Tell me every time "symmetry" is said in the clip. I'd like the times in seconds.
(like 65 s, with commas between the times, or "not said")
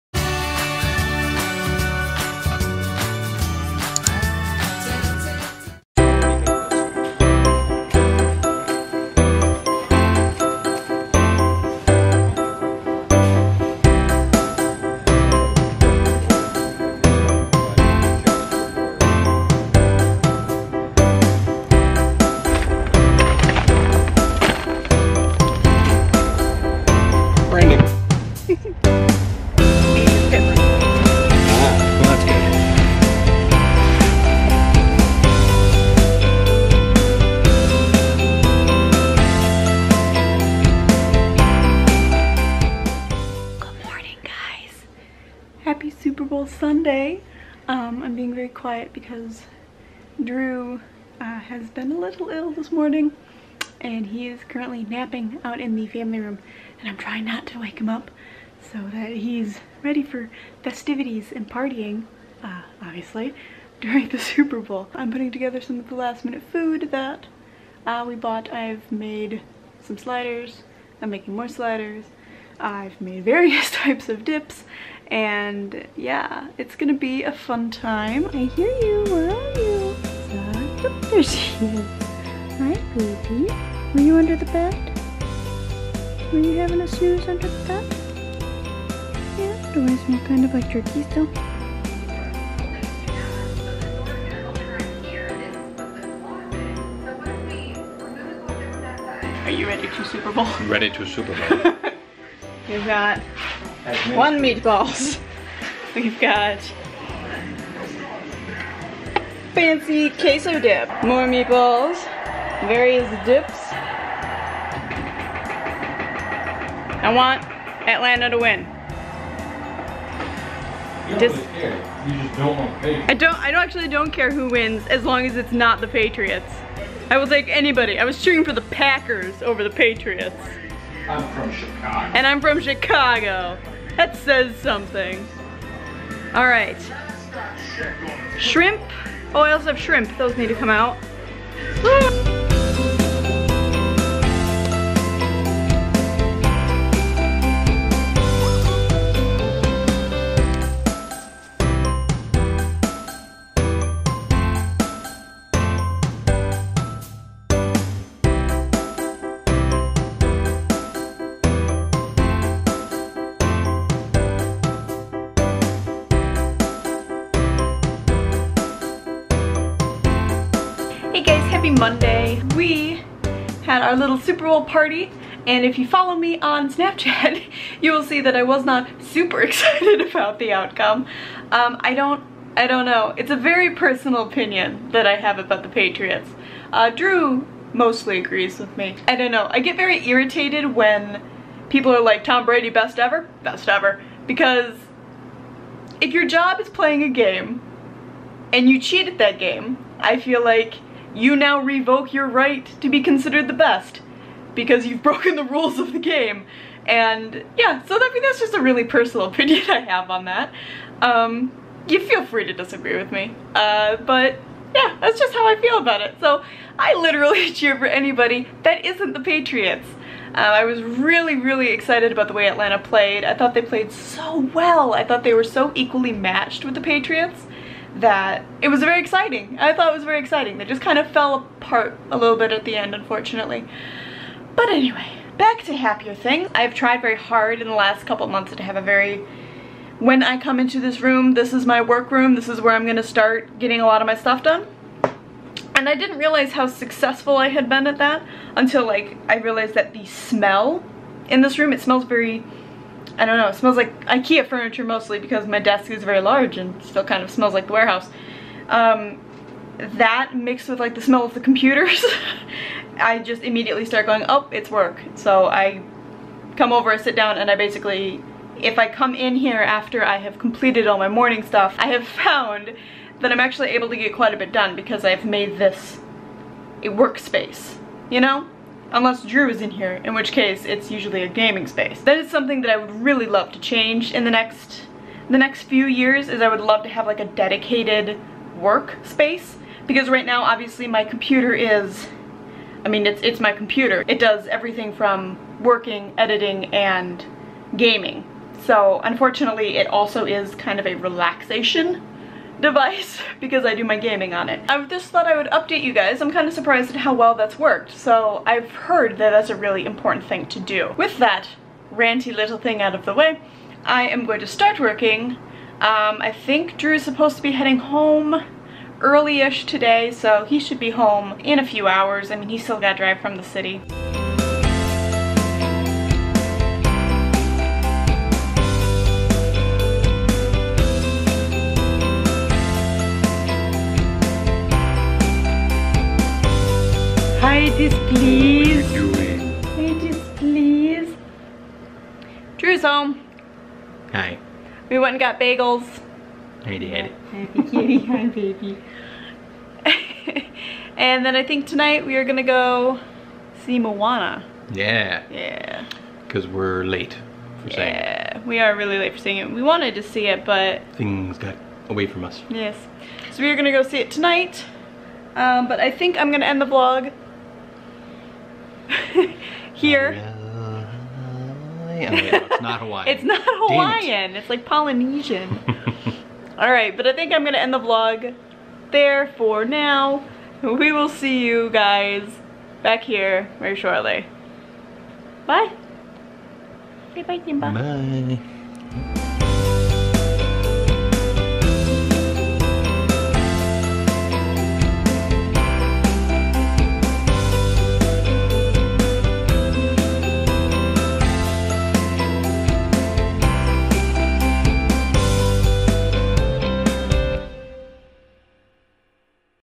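not said.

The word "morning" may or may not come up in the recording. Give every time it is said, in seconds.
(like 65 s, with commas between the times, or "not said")
52 s, 271 s.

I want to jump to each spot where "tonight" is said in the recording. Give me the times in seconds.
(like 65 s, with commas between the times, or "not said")
351 s, 364 s.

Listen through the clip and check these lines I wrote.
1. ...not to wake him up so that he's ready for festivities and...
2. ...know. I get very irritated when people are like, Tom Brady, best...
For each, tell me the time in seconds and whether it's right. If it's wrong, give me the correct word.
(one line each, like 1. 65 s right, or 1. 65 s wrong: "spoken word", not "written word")
1. 57 s right
2. 189 s right.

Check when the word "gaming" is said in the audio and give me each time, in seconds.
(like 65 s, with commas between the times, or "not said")
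281 s, 297 s, 303 s.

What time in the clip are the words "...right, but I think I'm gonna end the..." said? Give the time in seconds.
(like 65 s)
376 s.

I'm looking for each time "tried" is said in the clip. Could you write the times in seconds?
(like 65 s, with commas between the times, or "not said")
236 s.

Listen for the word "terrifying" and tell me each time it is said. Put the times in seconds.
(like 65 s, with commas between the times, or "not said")
not said.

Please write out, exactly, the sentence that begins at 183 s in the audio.
It's a very personal opinion that I have about the Patriots.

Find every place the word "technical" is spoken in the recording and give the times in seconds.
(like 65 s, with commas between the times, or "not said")
not said.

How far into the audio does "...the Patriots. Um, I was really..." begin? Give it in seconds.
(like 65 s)
219 s.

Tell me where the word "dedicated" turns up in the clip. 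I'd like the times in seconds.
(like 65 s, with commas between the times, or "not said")
287 s.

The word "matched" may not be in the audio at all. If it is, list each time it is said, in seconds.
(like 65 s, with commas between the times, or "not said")
226 s.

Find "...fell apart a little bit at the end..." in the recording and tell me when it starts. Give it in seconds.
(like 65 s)
231 s.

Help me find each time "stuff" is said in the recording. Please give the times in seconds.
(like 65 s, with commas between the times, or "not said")
244 s, 271 s.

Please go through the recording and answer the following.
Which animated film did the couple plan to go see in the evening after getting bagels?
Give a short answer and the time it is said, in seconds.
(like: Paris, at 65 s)
Moana, at 353 s.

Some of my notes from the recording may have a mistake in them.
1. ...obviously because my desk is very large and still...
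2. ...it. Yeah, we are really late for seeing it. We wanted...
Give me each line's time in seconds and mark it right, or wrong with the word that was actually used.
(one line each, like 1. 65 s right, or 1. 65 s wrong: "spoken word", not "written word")
1. 254 s wrong: "mostly", not "obviously"
2. 357 s right.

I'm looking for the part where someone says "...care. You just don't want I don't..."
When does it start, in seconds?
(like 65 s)
121 s.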